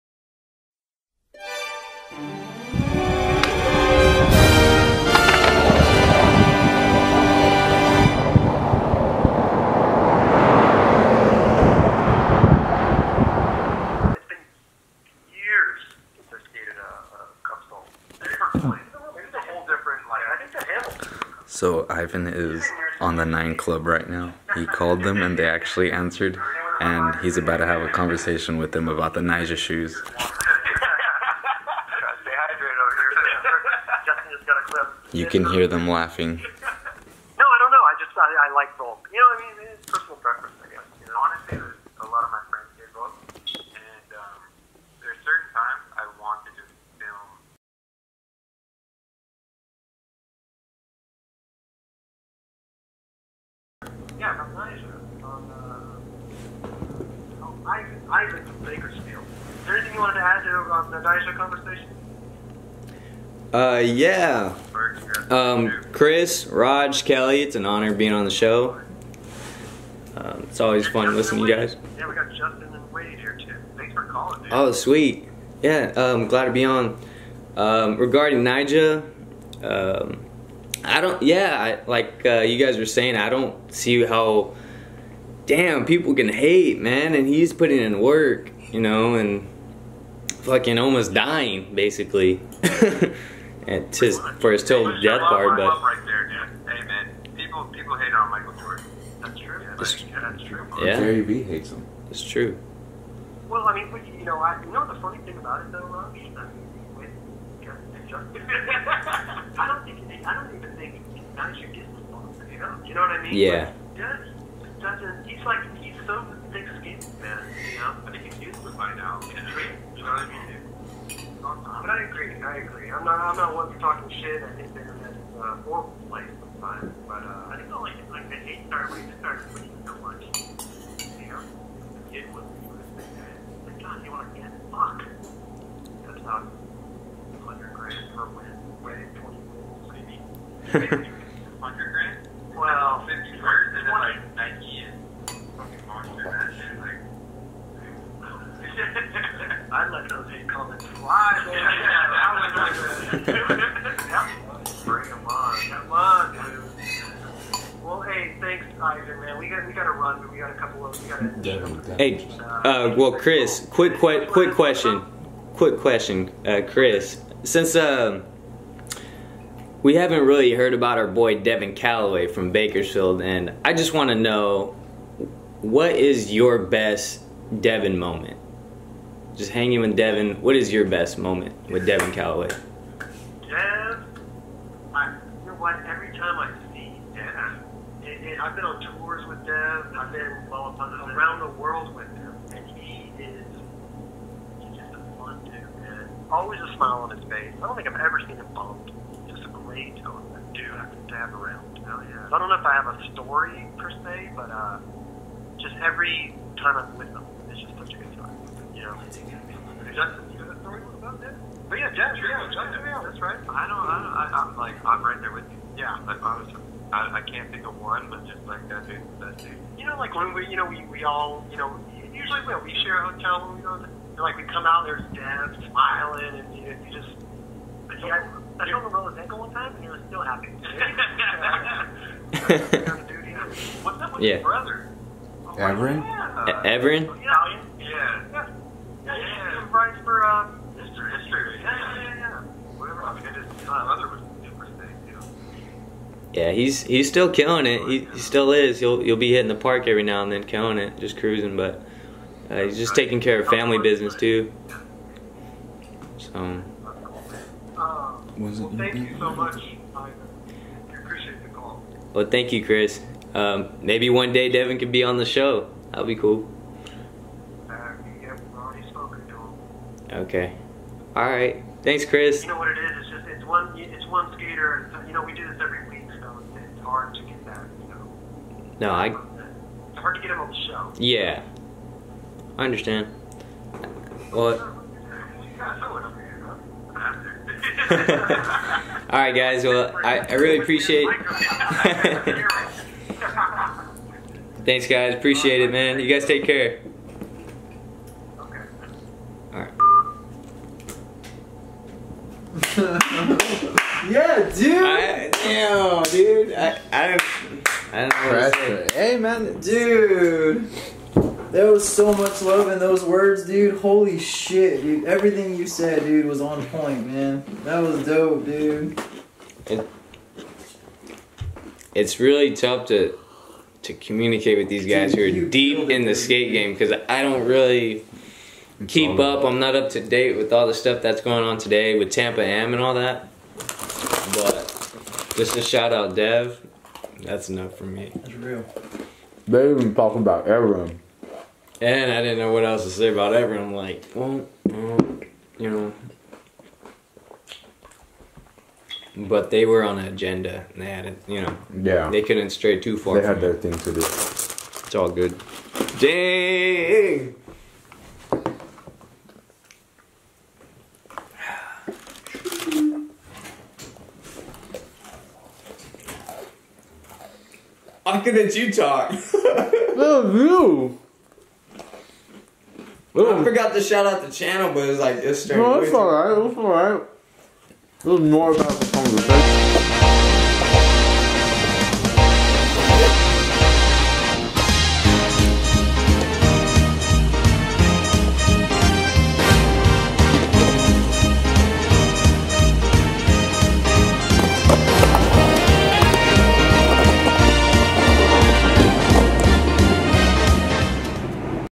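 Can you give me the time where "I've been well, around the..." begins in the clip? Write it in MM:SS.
03:09.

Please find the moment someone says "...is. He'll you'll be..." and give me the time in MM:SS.
04:08.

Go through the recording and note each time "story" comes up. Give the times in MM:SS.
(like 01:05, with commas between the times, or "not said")
03:23, 03:30.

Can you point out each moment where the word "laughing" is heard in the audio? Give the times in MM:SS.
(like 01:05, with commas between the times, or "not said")
00:35.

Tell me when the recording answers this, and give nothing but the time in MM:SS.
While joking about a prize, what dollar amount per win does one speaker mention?
02:16.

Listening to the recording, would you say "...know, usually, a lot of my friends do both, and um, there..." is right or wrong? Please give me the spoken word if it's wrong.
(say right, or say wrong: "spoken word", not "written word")
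wrong: "honestly", not "usually".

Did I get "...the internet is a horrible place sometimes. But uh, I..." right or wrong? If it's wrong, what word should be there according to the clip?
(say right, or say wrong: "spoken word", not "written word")
right.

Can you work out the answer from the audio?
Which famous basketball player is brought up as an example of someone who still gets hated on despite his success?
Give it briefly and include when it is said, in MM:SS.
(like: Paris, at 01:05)
Michael Jordan, at 01:38.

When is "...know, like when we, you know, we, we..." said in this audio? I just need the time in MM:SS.
03:39.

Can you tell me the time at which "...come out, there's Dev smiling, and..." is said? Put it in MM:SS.
03:44.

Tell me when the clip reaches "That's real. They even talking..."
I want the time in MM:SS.
05:38.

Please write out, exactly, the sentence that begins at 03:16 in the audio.
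Always a smile on his face.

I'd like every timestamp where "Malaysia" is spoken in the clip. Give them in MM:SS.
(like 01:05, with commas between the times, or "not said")
00:54, 01:01.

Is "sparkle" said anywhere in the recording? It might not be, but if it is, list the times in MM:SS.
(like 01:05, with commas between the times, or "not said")
not said.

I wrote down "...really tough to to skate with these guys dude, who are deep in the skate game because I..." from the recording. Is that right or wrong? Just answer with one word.
wrong.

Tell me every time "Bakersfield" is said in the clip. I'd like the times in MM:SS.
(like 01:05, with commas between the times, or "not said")
00:58, 02:52.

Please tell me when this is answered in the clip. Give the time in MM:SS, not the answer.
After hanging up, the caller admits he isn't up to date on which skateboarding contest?
05:32.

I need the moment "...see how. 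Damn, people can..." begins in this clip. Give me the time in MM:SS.
01:23.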